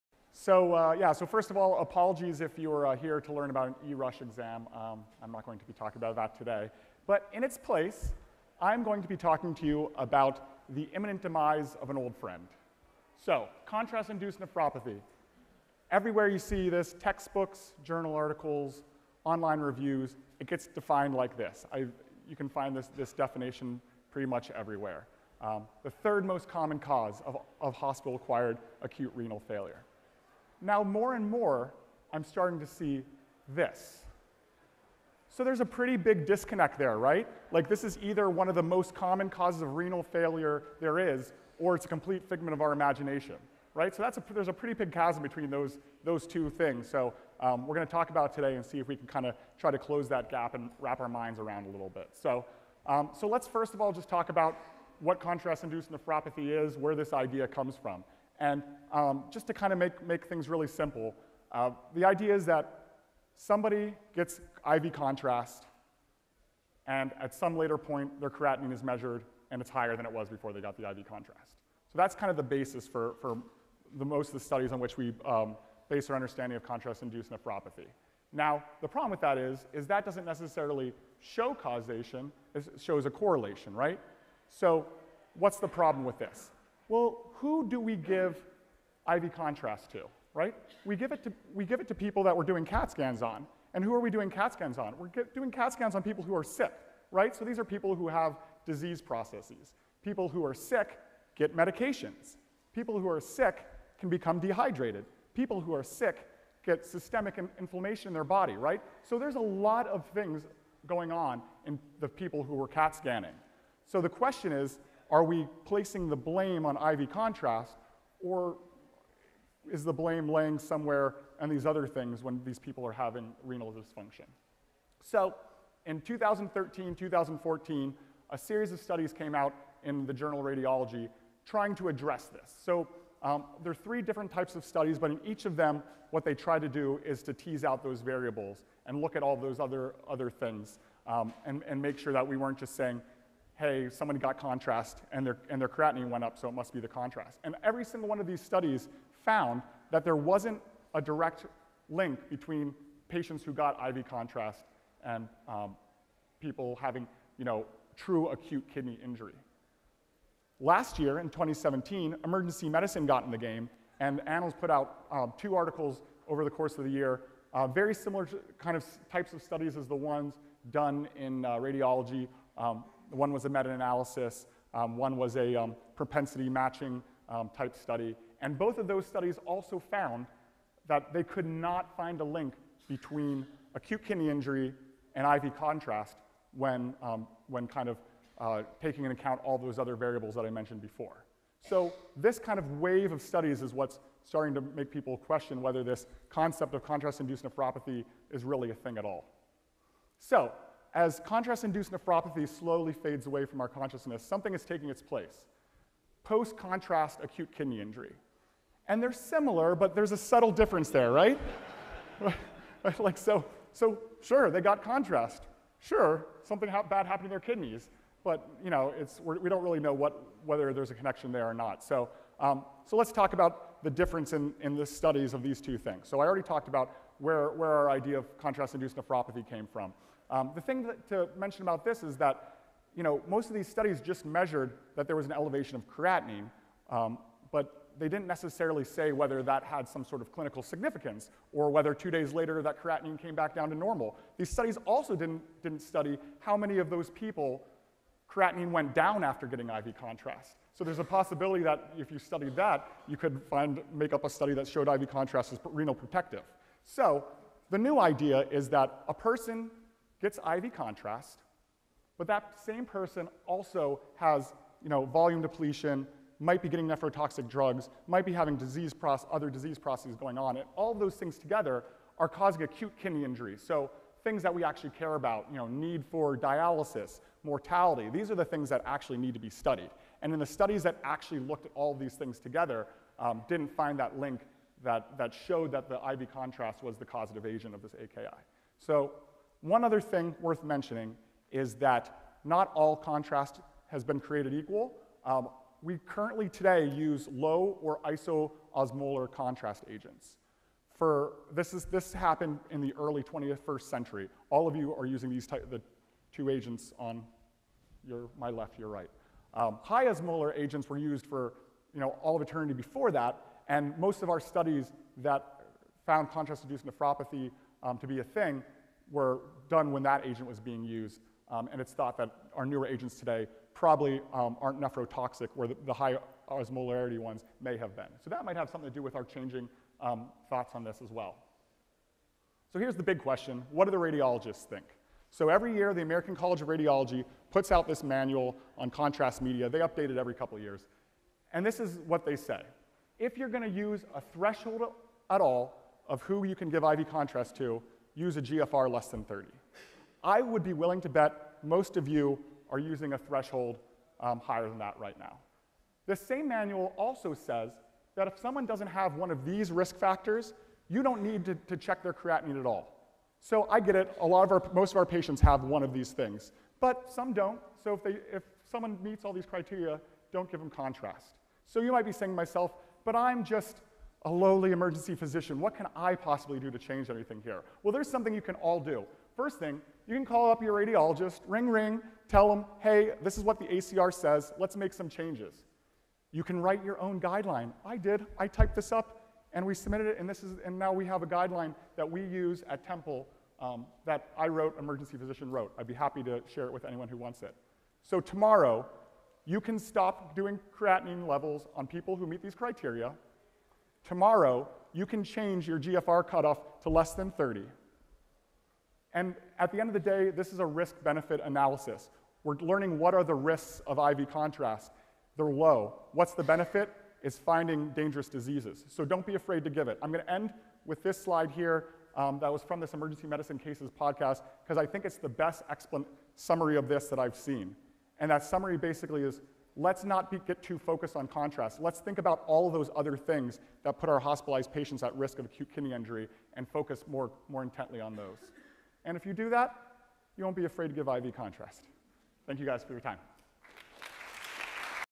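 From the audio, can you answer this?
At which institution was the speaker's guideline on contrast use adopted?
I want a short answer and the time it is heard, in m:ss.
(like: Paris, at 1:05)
Temple, at 6:32.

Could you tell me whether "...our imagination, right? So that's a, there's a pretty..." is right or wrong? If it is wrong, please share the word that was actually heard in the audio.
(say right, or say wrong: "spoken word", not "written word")
right.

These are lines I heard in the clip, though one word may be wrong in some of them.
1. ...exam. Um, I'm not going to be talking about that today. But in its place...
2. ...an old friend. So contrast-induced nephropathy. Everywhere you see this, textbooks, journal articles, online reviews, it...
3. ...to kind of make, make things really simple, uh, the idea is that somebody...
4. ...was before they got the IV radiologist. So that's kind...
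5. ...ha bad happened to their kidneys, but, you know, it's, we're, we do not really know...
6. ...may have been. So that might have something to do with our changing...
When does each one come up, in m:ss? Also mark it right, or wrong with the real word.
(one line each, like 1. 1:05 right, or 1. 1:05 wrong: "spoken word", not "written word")
1. 0:04 right
2. 0:11 right
3. 0:59 right
4. 1:10 wrong: "contrast", not "radiologist"
5. 3:36 right
6. 5:27 right.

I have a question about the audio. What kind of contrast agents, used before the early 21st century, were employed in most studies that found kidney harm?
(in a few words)
High osmolar agents.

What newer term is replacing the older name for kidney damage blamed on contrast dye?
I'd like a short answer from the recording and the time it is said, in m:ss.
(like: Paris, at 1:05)
Post-contrast acute kidney injury, at 3:26.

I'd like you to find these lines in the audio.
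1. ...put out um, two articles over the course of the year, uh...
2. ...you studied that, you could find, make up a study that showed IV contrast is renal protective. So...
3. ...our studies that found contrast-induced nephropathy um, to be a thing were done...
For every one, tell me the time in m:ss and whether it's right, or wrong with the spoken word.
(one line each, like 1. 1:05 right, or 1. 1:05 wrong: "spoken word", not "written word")
1. 2:44 right
2. 4:12 right
3. 5:14 right.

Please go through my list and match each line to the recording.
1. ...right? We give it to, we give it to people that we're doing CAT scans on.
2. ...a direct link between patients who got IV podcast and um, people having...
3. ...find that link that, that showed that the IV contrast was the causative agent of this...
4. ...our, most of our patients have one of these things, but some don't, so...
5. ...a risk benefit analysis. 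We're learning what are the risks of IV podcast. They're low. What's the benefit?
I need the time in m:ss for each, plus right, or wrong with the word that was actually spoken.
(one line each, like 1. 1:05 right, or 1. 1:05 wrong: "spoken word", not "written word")
1. 1:30 right
2. 2:30 wrong: "contrast", not "podcast"
3. 4:43 right
4. 6:04 right
5. 6:50 wrong: "contrast", not "podcast".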